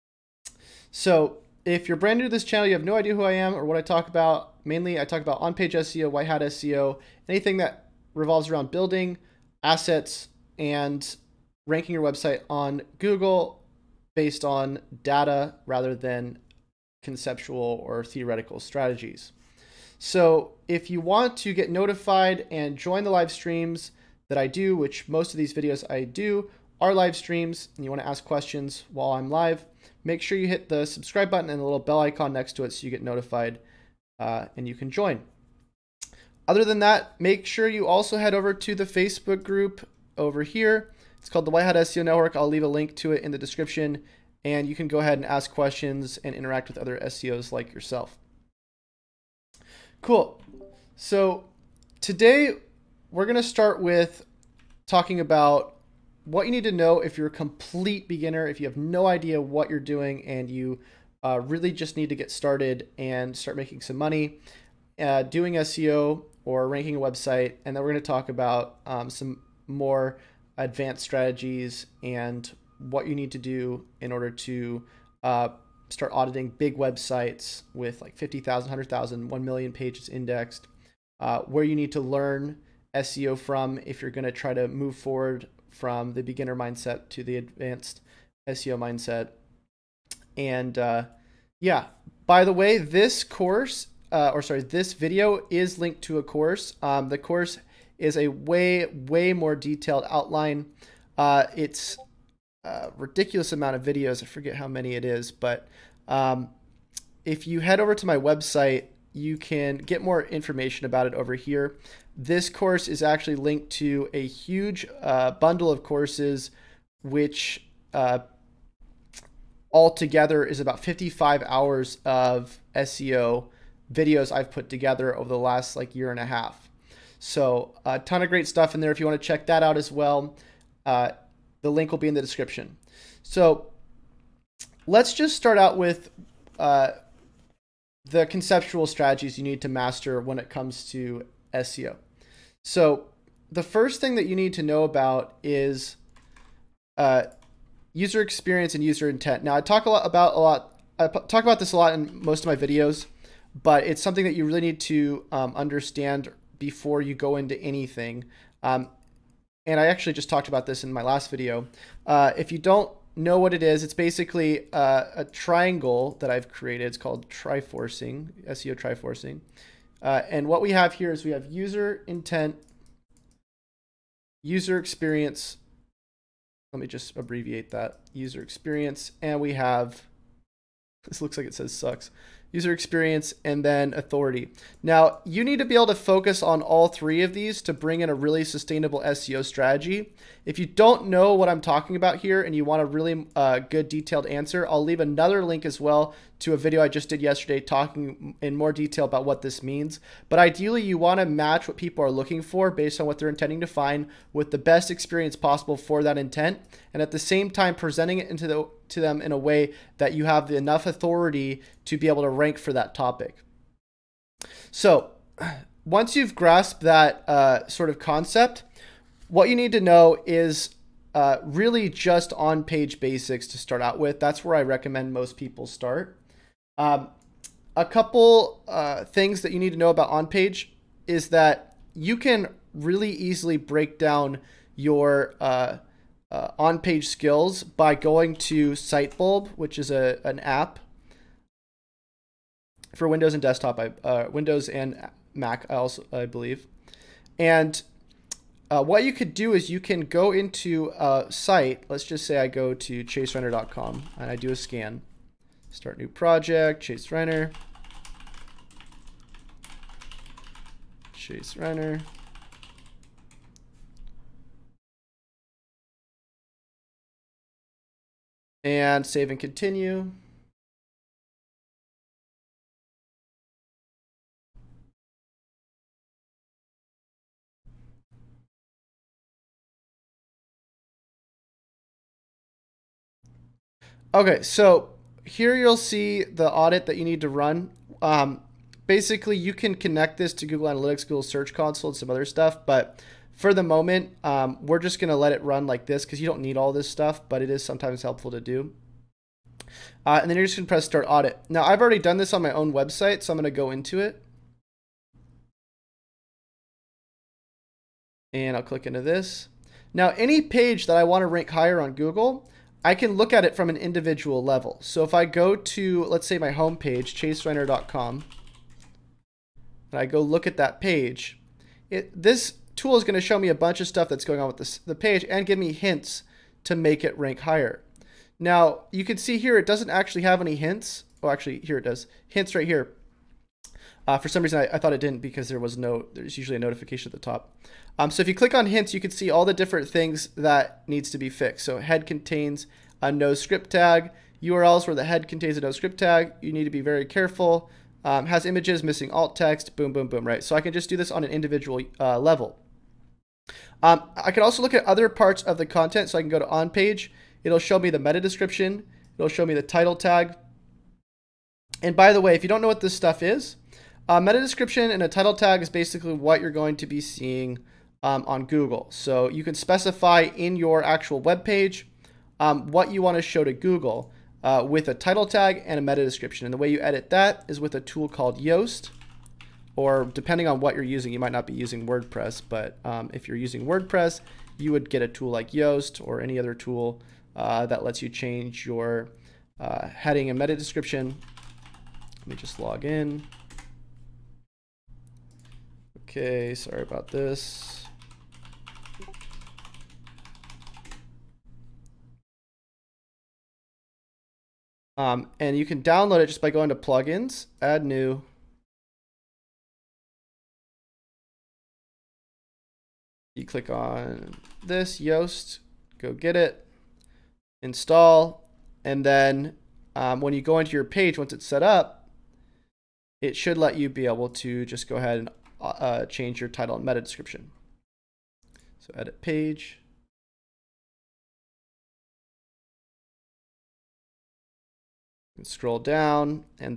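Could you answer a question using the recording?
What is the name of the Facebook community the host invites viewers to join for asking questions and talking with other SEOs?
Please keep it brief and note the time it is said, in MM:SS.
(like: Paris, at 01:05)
White Hat SEO Network, at 00:41.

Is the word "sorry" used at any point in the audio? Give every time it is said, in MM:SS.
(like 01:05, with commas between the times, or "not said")
01:34, 06:36.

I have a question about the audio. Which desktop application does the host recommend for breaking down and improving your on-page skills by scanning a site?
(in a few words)
Sitebulb.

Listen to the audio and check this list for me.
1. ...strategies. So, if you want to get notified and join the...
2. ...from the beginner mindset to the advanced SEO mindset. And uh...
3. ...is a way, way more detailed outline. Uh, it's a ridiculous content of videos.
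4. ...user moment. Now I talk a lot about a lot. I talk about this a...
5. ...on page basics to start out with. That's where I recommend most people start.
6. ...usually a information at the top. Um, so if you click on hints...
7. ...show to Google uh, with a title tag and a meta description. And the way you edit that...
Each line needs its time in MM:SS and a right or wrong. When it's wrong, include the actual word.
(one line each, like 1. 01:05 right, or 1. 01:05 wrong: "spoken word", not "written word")
1. 00:18 right
2. 01:25 right
3. 01:38 wrong: "amount", not "content"
4. 02:28 wrong: "intent", not "moment"
5. 03:42 right
6. 05:36 wrong: "notification", not "information"
7. 06:13 right.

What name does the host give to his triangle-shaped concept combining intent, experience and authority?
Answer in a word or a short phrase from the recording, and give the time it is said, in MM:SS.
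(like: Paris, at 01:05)
SEO Triforcing, at 02:48.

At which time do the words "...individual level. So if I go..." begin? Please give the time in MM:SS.
05:13.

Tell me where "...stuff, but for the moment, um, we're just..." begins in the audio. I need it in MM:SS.
04:52.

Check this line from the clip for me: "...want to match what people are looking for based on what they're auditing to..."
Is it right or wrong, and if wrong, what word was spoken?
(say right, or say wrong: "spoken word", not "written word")
wrong: "intending", not "auditing".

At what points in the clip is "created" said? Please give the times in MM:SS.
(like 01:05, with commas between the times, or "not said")
02:46.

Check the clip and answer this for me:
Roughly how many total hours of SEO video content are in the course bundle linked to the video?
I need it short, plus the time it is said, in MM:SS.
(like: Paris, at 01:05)
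55, at 02:00.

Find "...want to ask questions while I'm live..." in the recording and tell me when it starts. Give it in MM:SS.
00:27.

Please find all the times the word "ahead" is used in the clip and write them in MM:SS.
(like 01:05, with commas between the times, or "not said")
00:44, 07:04.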